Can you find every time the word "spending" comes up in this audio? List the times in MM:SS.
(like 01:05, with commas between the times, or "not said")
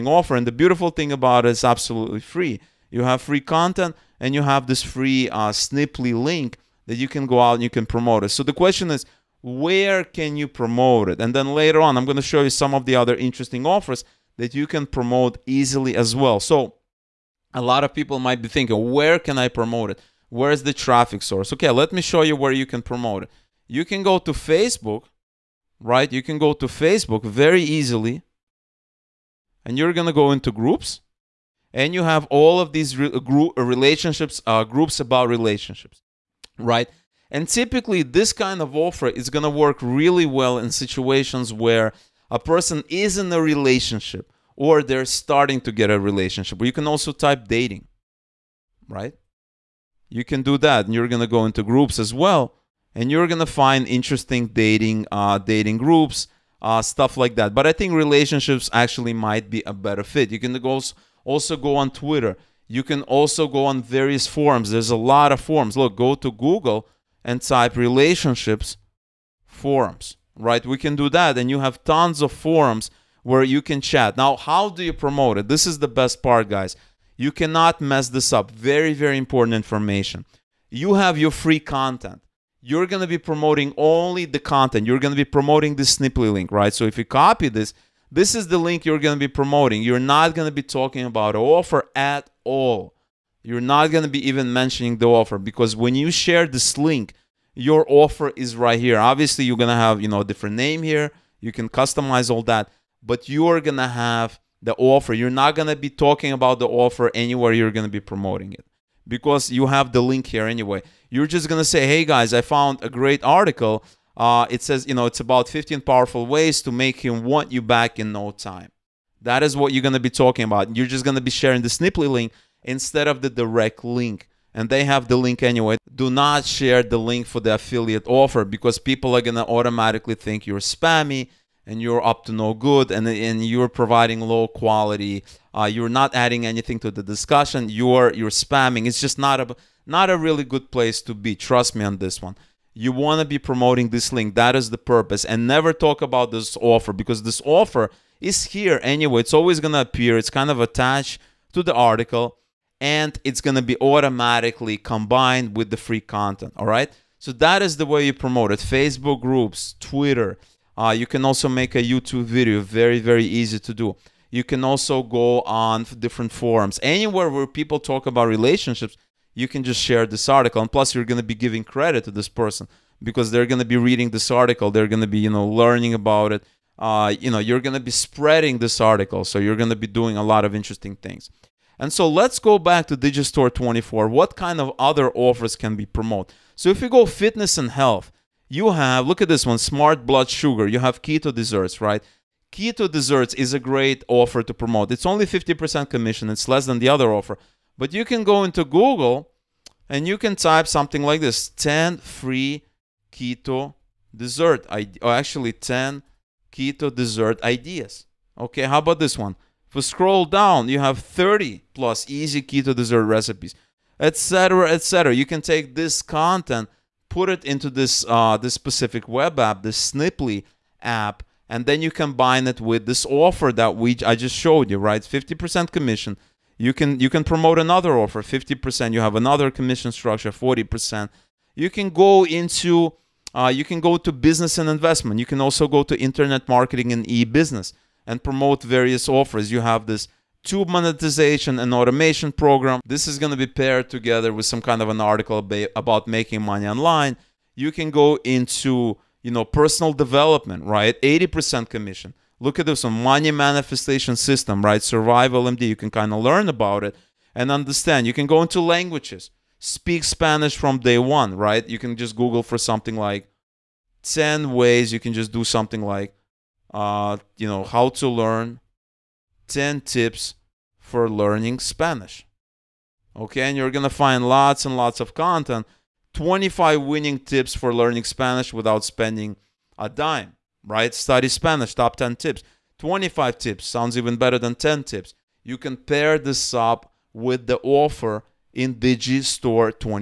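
04:38.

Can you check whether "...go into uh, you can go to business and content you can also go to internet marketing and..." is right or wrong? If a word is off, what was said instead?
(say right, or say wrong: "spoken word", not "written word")
wrong: "investment", not "content".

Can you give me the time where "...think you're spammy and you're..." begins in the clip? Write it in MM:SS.
02:10.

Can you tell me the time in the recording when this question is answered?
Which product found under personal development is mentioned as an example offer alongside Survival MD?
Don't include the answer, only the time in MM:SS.
04:13.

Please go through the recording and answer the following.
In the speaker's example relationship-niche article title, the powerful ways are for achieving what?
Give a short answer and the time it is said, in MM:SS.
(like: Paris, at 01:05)
make him want you back, at 01:56.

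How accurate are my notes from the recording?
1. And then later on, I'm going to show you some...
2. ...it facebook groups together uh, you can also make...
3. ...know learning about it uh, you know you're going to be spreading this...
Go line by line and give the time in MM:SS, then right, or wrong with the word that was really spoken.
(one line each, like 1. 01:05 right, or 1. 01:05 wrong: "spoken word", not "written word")
1. 00:11 right
2. 02:38 wrong: "twitter", not "together"
3. 02:55 right.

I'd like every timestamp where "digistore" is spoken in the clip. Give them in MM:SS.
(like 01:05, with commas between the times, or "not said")
03:02, 04:48.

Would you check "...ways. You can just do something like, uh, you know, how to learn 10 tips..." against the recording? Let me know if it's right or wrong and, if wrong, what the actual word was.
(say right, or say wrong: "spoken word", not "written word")
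right.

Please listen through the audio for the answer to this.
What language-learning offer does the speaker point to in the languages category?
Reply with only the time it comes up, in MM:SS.
04:19.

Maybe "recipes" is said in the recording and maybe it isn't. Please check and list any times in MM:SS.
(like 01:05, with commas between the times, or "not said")
03:33.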